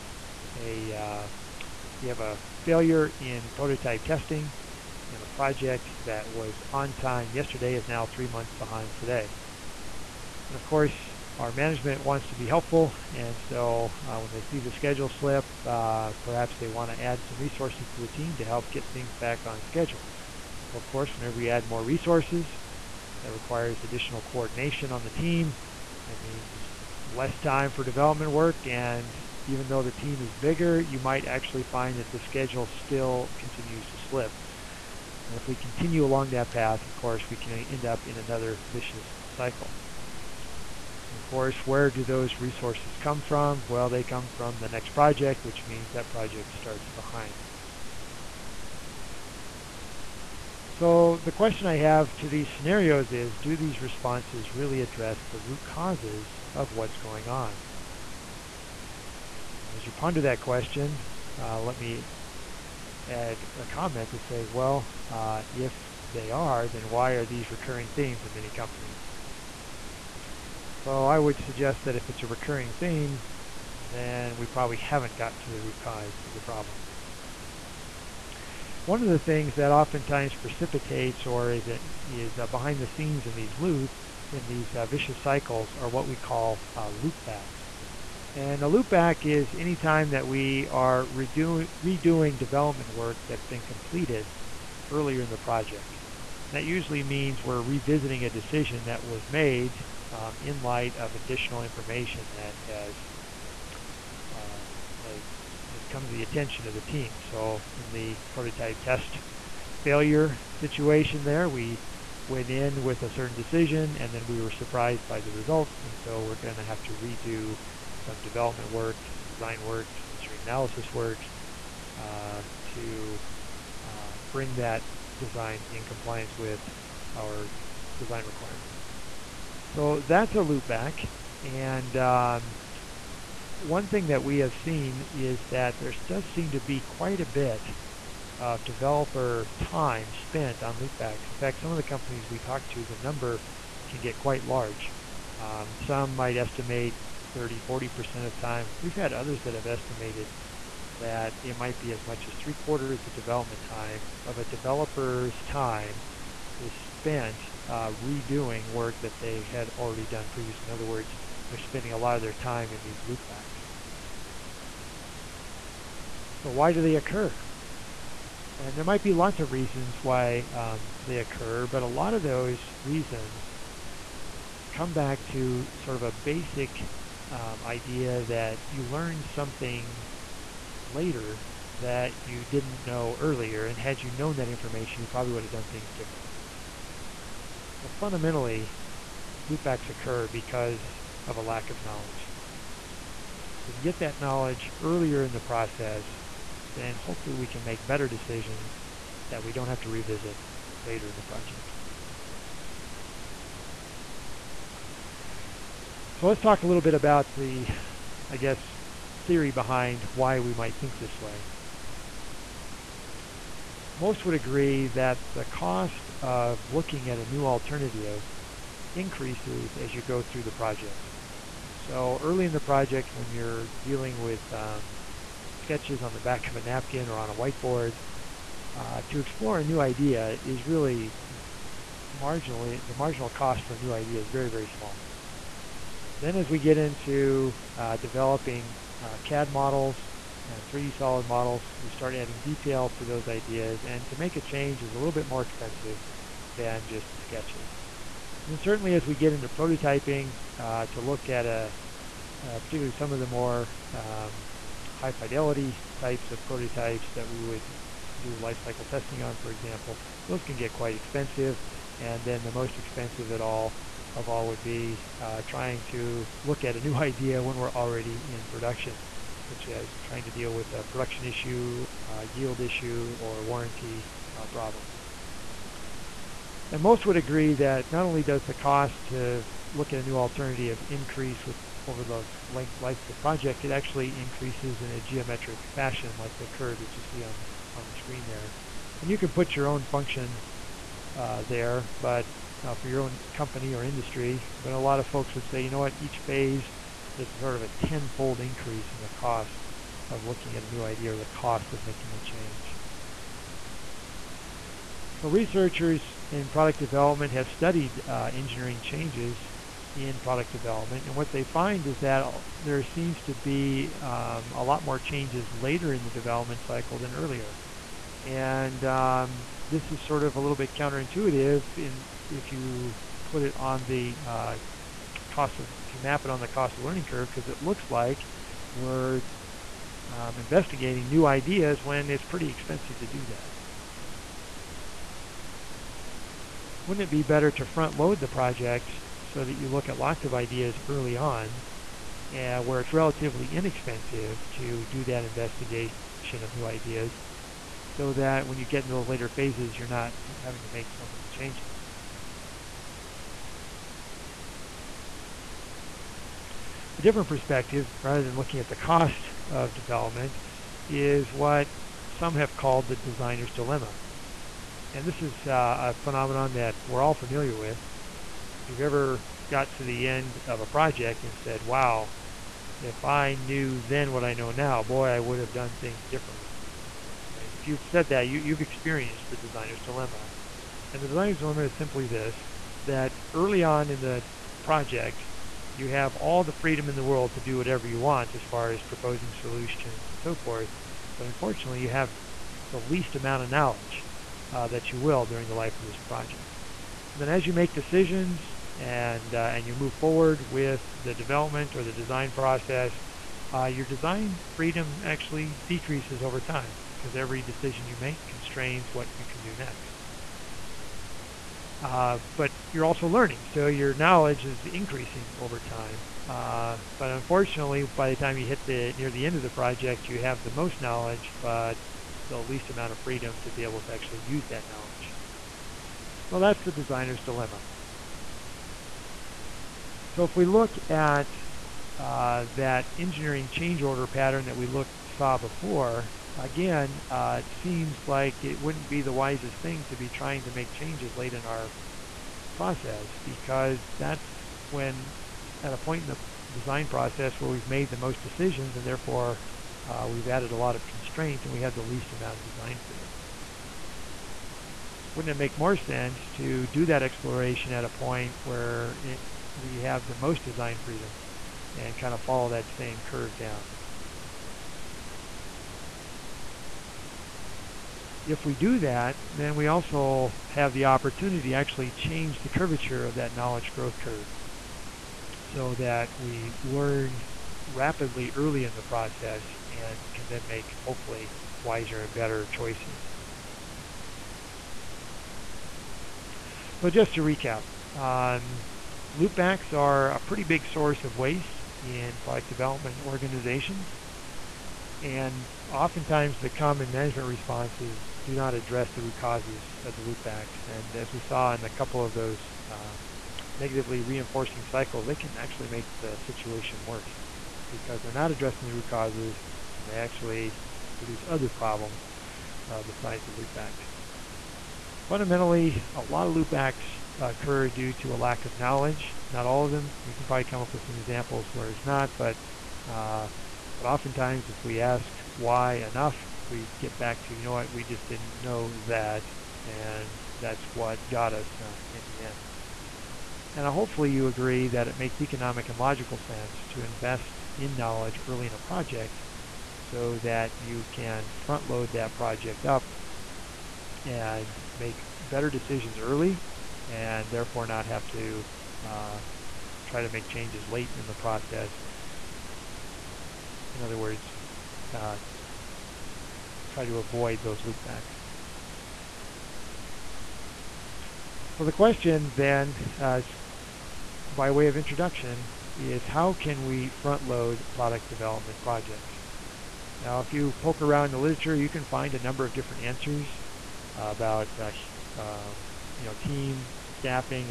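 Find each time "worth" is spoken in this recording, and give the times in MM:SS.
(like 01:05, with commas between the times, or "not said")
not said.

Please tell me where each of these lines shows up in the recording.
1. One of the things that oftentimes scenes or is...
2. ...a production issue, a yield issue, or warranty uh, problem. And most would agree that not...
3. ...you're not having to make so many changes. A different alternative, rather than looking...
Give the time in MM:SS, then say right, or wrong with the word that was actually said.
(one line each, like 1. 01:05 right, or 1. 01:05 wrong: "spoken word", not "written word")
1. 01:18 wrong: "precipitates", not "scenes"
2. 04:30 right
3. 05:49 wrong: "perspective", not "alternative".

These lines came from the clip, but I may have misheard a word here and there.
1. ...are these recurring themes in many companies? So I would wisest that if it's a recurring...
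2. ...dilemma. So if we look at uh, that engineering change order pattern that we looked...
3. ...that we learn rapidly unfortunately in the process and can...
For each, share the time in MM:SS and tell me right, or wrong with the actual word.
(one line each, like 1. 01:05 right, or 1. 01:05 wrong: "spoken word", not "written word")
1. 01:07 wrong: "suggest", not "wisest"
2. 07:07 right
3. 07:55 wrong: "early", not "unfortunately".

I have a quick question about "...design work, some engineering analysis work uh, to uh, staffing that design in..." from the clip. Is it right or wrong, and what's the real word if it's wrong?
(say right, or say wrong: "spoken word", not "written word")
wrong: "bring", not "staffing".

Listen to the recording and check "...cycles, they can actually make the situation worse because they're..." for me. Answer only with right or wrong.
right.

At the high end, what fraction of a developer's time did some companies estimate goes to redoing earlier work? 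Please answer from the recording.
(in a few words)
three quarters.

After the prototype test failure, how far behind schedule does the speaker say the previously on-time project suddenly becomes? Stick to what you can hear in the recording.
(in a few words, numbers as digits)
3 months.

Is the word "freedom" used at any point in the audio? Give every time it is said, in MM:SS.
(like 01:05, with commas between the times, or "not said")
06:26, 06:44, 07:02, 07:32, 07:40.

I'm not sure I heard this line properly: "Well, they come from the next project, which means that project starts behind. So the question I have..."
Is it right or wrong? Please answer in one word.
right.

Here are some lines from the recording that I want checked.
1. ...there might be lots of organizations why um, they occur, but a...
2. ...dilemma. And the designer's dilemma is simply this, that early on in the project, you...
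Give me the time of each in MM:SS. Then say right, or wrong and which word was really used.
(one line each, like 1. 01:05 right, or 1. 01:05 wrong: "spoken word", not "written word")
1. 02:48 wrong: "reasons", not "organizations"
2. 06:19 right.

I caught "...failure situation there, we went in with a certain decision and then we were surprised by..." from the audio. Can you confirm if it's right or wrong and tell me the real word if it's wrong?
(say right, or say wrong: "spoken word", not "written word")
right.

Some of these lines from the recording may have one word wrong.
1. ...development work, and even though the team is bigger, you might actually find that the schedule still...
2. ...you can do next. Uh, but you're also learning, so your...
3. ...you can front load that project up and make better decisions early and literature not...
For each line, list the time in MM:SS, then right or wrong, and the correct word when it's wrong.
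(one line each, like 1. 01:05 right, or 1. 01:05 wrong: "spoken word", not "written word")
1. 00:27 right
2. 06:49 right
3. 09:00 wrong: "therefore", not "literature".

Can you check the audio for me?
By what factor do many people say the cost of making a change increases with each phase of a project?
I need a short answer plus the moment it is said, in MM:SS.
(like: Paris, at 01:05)
tenfold, at 04:57.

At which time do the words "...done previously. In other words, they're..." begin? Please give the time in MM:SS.
02:40.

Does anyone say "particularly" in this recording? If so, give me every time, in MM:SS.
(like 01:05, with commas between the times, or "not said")
04:12.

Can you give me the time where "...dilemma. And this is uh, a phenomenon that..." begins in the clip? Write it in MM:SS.
06:03.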